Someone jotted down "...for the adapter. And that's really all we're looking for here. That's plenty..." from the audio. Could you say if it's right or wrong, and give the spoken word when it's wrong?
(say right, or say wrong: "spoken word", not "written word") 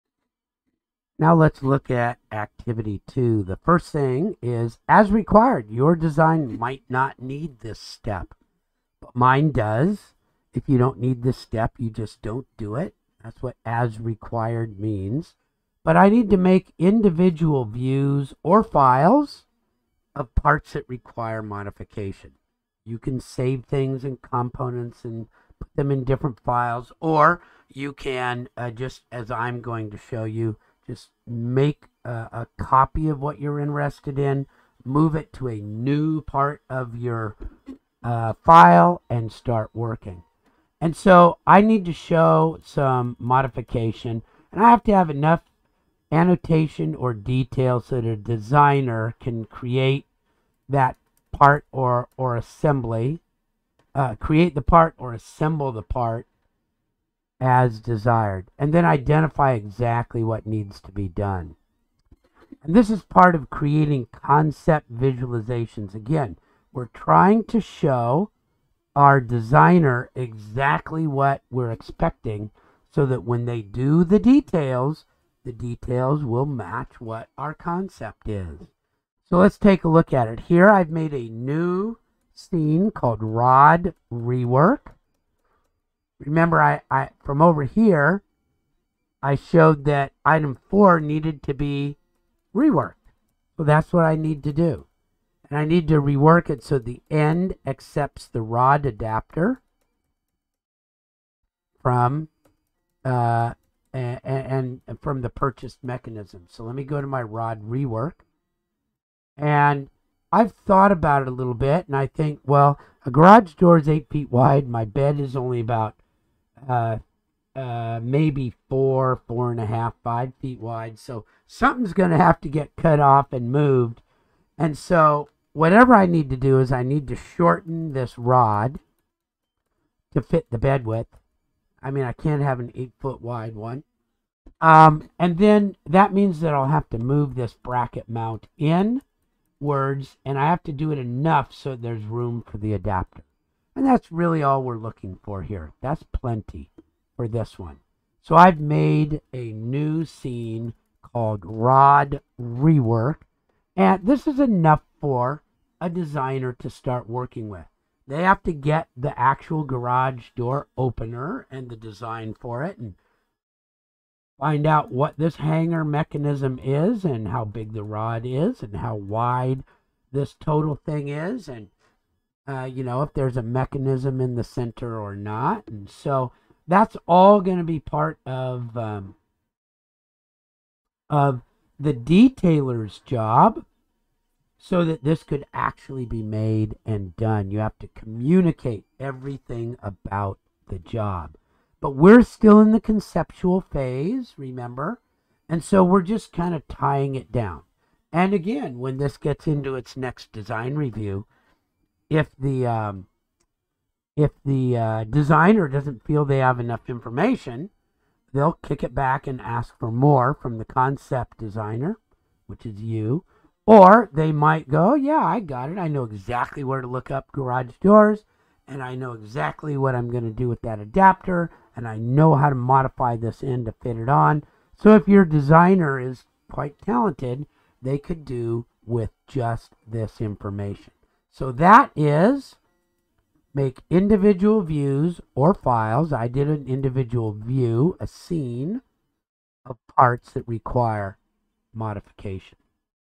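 right.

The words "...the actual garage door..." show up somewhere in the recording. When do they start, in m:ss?
2:38.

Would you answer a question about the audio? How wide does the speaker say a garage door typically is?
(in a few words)
8 feet.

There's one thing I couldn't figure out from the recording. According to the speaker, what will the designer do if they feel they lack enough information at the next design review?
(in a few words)
Kick it back.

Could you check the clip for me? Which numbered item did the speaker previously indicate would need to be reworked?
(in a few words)
Item 4.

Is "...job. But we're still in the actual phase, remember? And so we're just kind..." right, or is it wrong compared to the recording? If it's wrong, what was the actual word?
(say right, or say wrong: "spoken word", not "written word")
wrong: "conceptual", not "actual".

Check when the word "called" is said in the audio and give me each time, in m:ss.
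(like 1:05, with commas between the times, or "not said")
1:22, 2:31.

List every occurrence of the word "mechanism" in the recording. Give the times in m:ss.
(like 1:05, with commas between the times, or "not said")
1:45, 2:45, 2:53.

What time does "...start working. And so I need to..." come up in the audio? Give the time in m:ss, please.
0:39.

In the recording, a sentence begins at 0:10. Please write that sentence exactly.
If you don't need this step, you just don't do it.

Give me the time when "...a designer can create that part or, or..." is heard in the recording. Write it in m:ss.
0:48.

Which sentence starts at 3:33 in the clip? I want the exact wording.
Or they might go, yeah, I got it.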